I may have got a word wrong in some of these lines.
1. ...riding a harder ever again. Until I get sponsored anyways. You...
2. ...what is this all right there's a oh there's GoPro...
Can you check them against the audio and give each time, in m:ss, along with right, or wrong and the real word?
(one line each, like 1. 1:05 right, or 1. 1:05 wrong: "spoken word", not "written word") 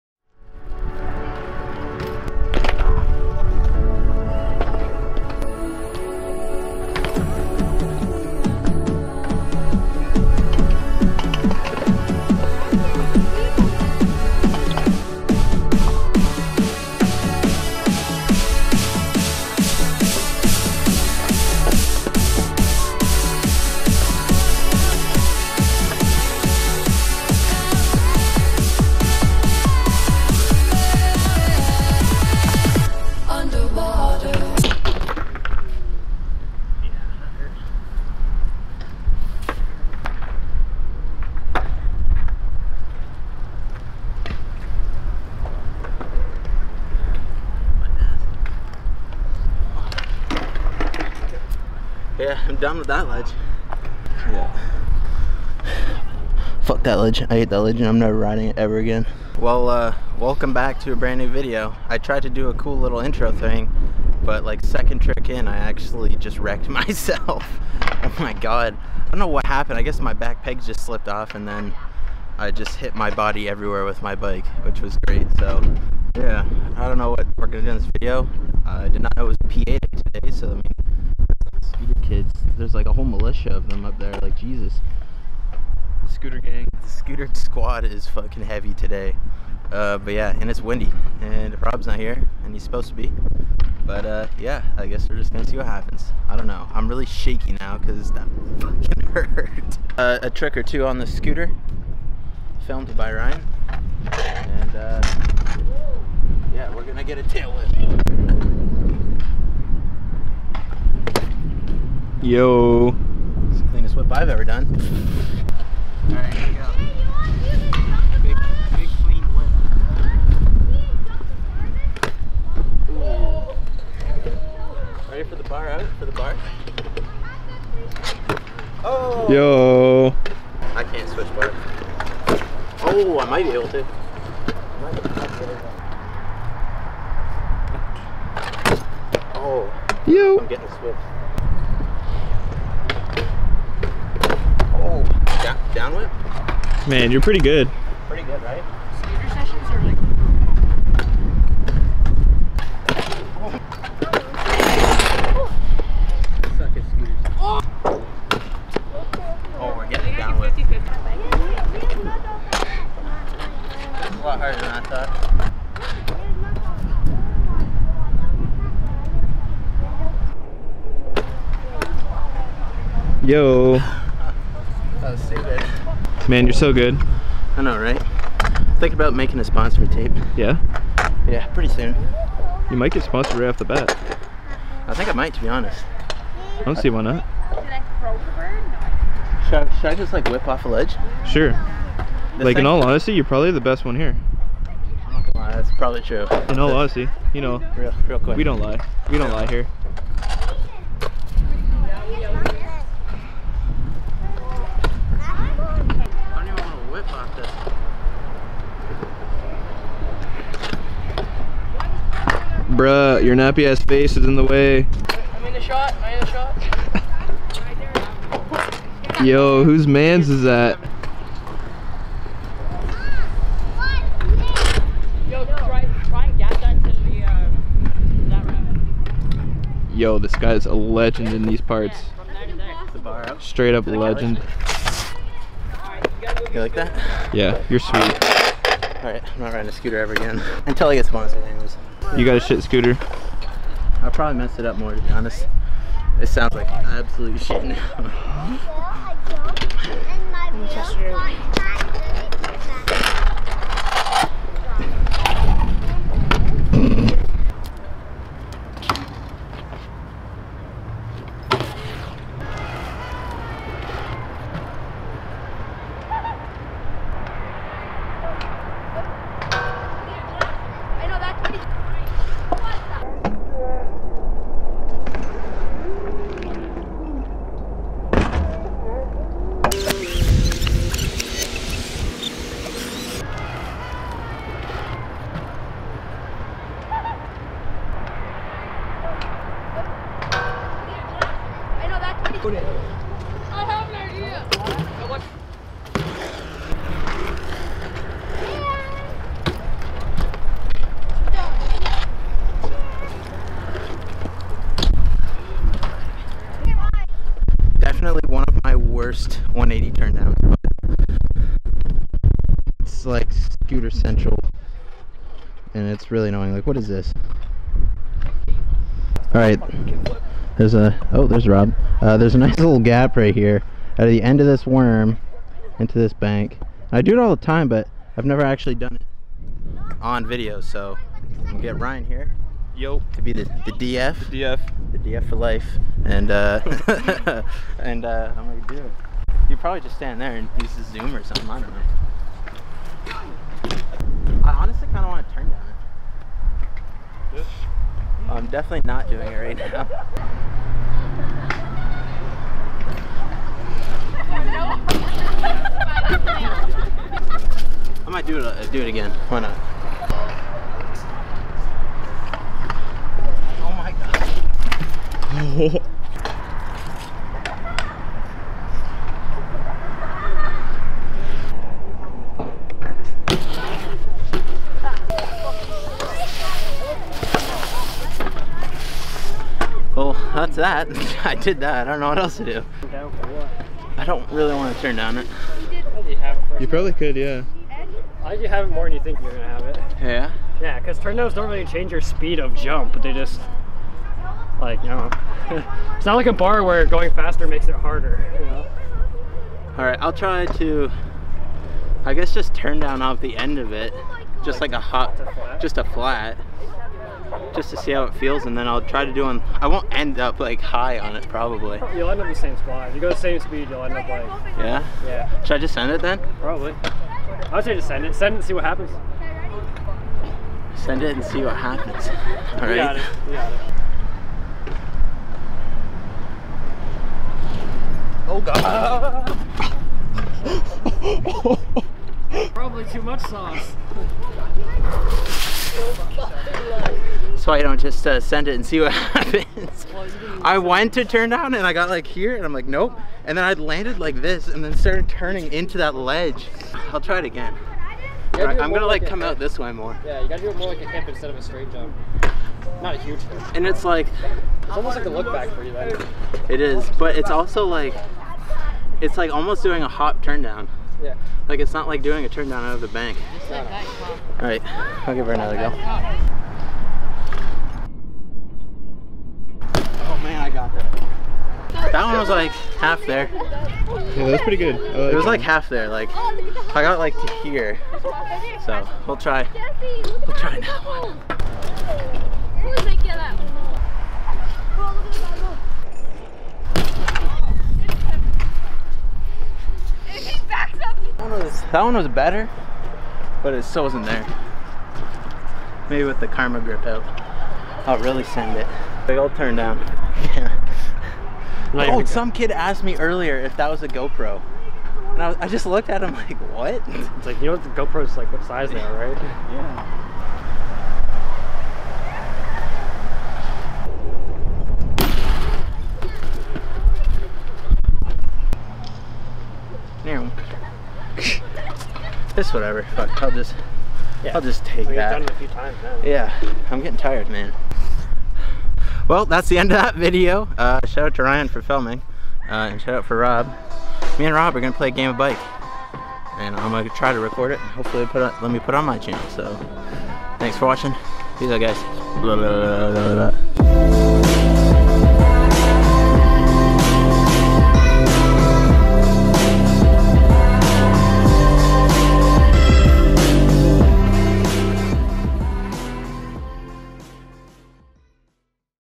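1. 3:59 wrong: "scooter", not "harder"
2. 5:16 wrong: "Rob", not "GoPro".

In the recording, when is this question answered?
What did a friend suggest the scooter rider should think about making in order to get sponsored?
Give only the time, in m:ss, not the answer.
2:59.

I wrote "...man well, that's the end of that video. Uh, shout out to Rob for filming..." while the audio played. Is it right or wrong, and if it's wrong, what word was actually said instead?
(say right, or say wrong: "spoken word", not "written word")
wrong: "Ryan", not "Rob".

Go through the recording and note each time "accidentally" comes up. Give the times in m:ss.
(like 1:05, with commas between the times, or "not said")
not said.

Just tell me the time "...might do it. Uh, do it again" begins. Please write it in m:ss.
5:58.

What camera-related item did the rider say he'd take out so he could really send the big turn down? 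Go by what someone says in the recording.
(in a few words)
karma grip.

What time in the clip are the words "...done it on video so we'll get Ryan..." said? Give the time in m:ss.
5:28.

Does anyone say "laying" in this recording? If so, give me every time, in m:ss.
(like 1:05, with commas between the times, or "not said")
not said.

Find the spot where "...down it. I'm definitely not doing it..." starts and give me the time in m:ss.
5:45.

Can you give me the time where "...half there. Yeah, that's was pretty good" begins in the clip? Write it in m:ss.
7:52.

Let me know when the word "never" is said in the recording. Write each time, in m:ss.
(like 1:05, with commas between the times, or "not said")
0:57, 5:28.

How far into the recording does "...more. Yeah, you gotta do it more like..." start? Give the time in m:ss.
7:29.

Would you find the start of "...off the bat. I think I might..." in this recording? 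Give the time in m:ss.
3:03.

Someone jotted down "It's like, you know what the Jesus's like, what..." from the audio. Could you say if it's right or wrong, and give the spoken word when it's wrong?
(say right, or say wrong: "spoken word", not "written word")
wrong: "GoPro", not "Jesus".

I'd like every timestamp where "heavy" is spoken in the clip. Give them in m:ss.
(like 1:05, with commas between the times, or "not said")
1:28.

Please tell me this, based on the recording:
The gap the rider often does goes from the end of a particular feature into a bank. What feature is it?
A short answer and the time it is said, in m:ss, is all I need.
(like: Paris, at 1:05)
worm, at 5:24.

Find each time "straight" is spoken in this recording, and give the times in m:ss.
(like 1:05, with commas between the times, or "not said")
3:53, 7:31.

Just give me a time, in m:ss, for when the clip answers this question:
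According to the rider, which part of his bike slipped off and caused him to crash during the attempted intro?
1:10.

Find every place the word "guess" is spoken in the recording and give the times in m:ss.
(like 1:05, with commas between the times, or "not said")
1:09, 1:34, 6:42.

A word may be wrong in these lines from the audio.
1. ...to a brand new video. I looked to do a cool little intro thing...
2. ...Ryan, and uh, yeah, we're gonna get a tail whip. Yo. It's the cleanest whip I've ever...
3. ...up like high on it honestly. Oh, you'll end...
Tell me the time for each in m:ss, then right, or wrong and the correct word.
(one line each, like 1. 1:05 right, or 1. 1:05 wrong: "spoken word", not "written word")
1. 1:00 wrong: "tried", not "looked"
2. 1:43 right
3. 6:50 wrong: "probably", not "honestly".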